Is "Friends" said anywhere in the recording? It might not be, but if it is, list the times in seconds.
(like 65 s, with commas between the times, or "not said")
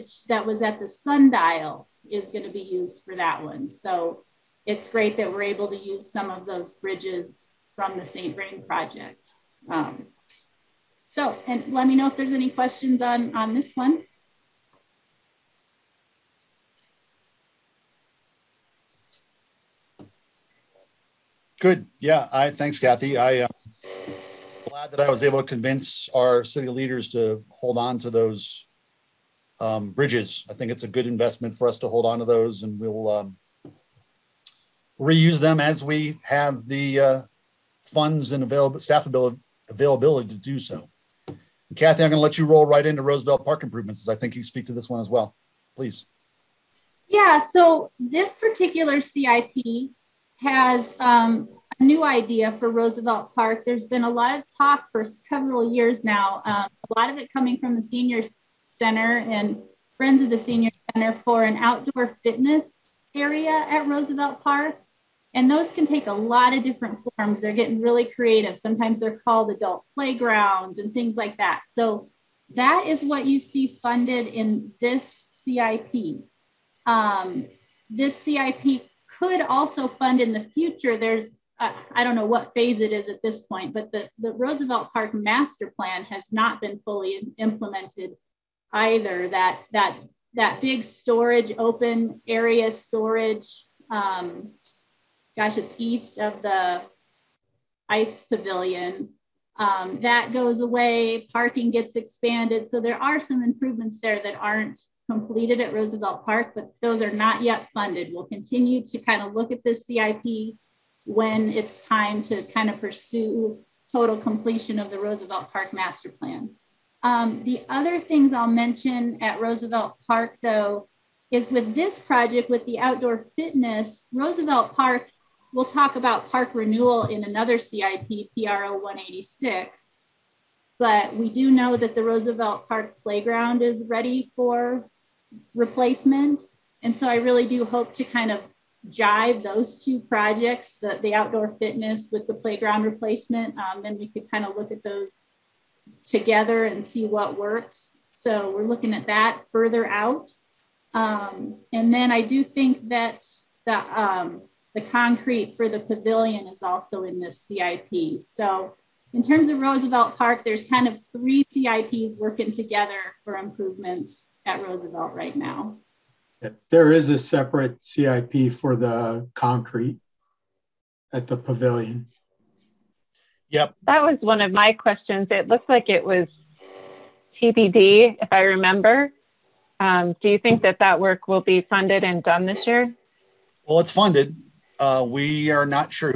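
59 s.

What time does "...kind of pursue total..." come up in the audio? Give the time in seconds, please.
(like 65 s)
112 s.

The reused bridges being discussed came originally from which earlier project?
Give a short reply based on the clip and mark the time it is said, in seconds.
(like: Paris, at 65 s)
St. Vrain project, at 8 s.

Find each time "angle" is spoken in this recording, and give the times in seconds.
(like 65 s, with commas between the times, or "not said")
not said.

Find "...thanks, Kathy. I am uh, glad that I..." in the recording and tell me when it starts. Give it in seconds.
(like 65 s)
22 s.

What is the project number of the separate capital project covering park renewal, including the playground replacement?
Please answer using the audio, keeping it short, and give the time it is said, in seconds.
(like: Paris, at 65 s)
PRO 186, at 128 s.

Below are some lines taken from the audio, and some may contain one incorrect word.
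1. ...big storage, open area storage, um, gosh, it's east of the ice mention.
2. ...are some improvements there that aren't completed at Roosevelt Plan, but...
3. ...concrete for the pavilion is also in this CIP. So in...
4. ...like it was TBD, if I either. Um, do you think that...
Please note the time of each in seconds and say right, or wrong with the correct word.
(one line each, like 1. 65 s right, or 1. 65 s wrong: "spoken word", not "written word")
1. 90 s wrong: "pavilion", not "mention"
2. 103 s wrong: "Park", not "Plan"
3. 154 s right
4. 175 s wrong: "remember", not "either".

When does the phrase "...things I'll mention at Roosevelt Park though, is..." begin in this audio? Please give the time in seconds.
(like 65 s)
118 s.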